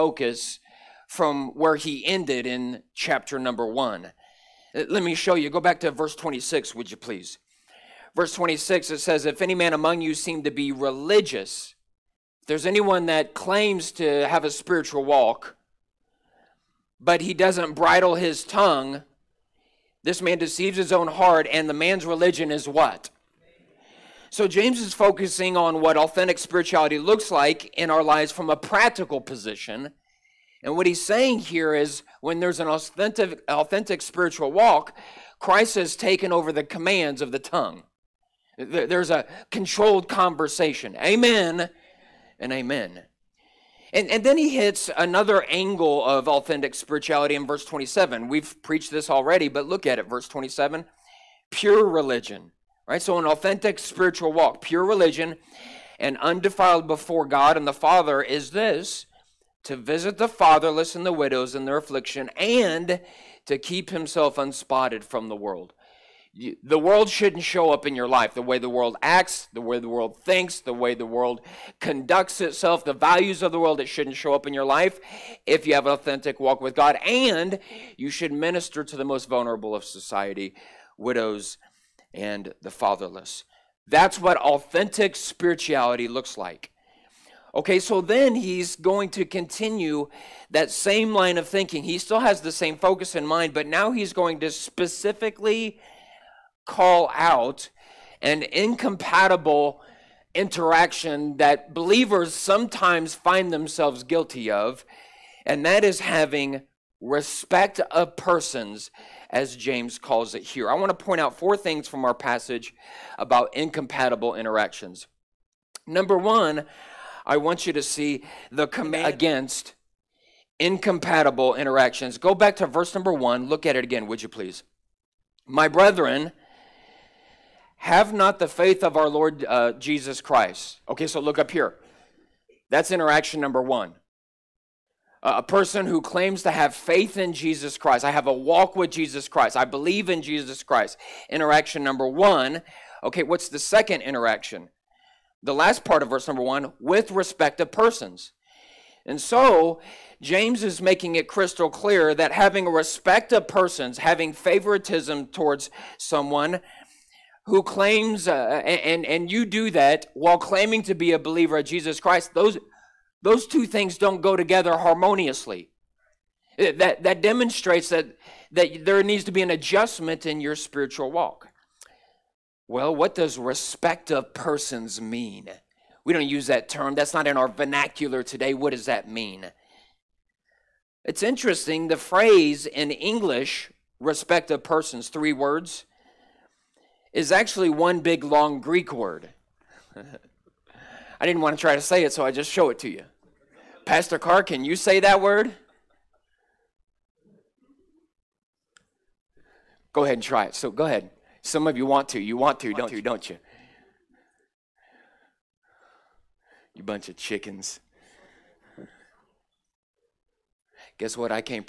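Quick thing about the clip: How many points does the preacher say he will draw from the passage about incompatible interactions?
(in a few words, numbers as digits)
4.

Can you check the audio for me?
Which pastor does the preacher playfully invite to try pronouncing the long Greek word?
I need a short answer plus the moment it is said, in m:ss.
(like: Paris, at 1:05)
Pastor Carr, at 3:13.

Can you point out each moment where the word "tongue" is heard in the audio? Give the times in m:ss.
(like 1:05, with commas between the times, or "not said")
0:18, 0:37.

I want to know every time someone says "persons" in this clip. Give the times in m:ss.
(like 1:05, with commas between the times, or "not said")
1:48, 2:15, 2:27, 2:33, 2:54, 3:04.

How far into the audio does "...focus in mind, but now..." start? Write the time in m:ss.
1:32.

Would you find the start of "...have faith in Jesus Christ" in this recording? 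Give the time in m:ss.
2:16.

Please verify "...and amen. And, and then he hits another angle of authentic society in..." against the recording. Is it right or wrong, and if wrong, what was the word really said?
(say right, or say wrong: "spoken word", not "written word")
wrong: "spirituality", not "society".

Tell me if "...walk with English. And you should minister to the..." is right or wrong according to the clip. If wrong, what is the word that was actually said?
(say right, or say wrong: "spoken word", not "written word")
wrong: "God", not "English".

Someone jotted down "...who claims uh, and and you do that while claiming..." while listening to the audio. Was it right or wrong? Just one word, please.
right.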